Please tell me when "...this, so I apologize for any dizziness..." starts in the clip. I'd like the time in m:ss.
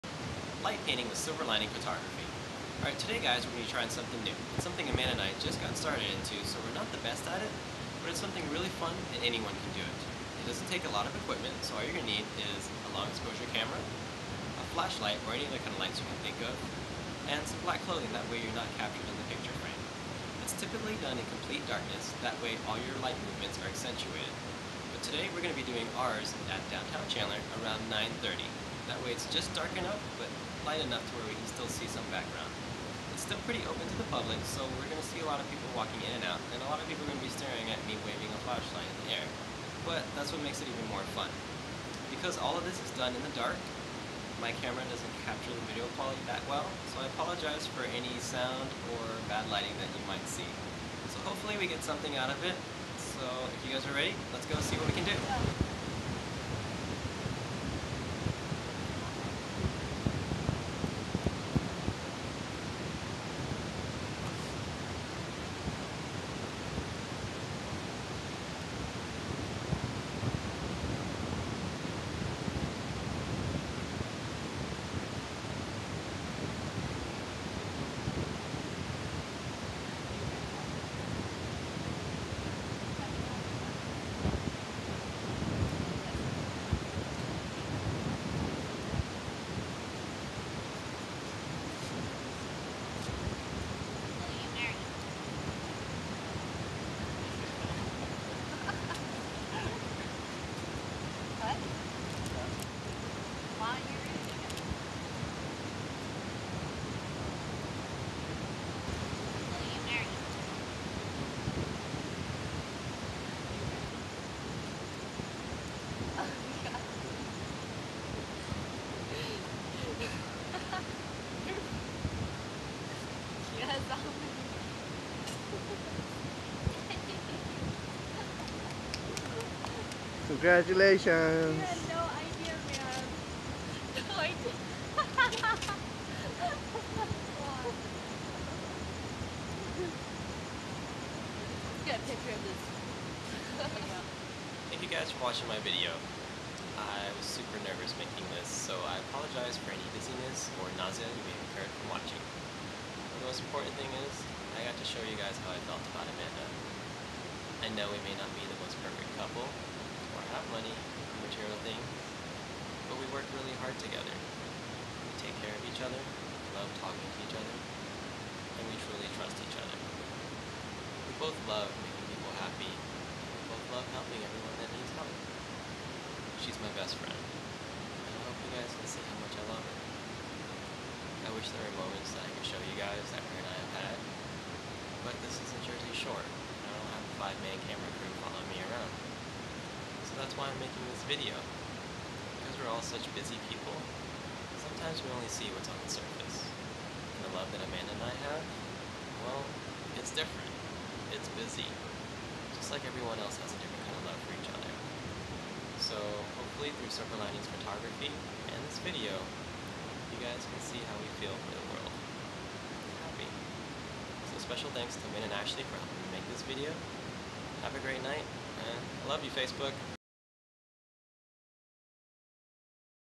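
2:28.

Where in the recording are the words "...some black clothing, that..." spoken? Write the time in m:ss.
0:17.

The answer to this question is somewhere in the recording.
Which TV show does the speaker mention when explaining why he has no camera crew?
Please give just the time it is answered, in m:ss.
3:05.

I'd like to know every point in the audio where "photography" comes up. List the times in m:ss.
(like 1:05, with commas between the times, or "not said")
0:01, 3:27.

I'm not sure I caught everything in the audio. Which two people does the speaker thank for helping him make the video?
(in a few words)
Min and Ashley.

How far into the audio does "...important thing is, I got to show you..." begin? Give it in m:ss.
2:33.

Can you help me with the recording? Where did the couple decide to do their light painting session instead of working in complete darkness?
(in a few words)
Downtown Chandler.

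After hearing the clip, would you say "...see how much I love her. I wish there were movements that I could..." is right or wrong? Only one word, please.
wrong.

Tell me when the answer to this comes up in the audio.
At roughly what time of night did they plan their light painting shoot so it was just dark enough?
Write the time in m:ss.
0:27.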